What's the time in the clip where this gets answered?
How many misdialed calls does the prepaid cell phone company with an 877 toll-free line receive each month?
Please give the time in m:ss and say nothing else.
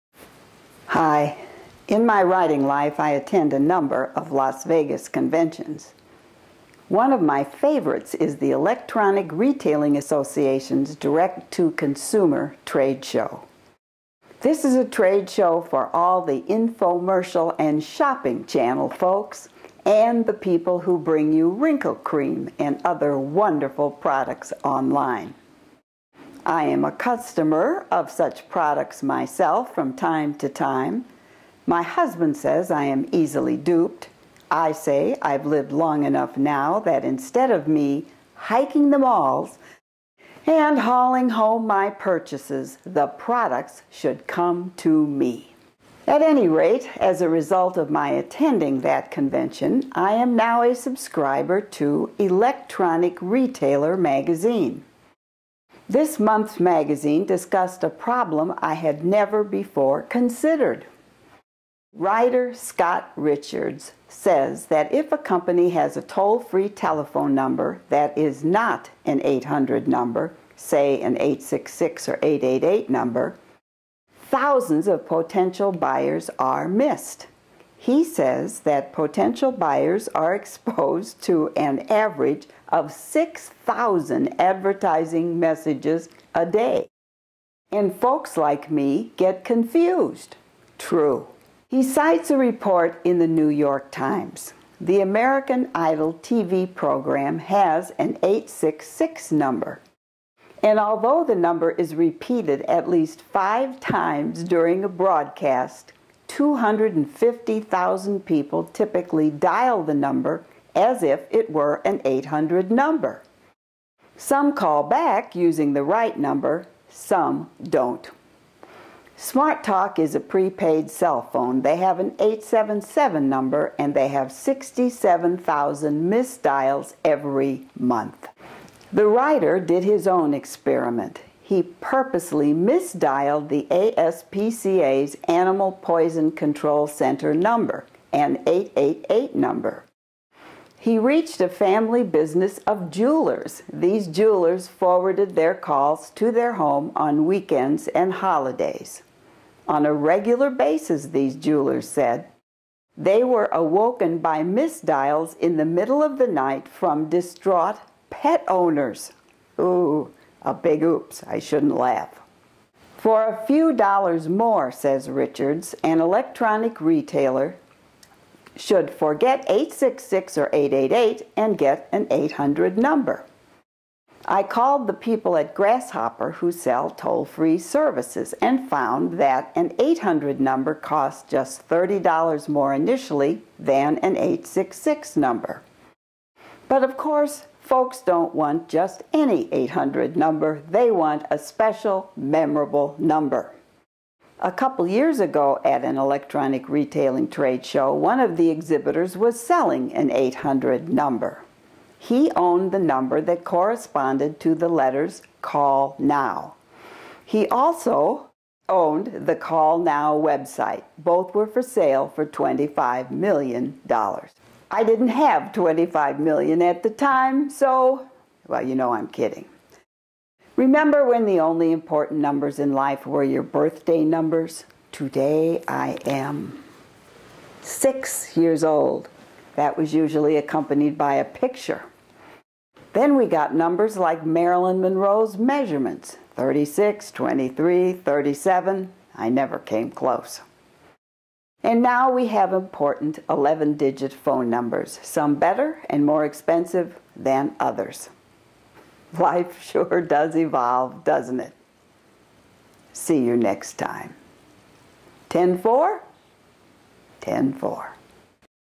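2:04.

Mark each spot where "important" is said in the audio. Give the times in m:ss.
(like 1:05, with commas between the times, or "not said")
3:41, 4:02.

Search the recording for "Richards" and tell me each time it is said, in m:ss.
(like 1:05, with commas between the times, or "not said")
1:03, 2:45.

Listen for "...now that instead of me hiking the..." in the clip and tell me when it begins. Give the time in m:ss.
0:36.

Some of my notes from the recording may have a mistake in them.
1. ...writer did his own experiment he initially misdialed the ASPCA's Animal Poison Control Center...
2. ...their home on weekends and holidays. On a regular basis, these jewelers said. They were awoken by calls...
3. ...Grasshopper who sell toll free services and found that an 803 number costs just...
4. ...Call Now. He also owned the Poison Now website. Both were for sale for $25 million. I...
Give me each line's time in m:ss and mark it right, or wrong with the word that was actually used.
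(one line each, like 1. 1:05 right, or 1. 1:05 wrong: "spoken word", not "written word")
1. 2:09 wrong: "purposely", not "initially"
2. 2:26 wrong: "misdials", not "calls"
3. 2:55 wrong: "800", not "803"
4. 3:25 wrong: "Call", not "Poison".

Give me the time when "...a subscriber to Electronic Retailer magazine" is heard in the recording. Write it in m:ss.
0:50.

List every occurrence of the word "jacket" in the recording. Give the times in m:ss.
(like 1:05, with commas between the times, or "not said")
not said.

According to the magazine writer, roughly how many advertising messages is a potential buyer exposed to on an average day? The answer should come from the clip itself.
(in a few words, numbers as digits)
6,000.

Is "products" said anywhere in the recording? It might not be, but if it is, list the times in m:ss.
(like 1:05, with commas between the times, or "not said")
0:23, 0:28, 0:43.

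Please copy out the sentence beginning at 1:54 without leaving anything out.
Some call back using the right number, some don't.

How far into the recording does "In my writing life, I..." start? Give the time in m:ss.
0:01.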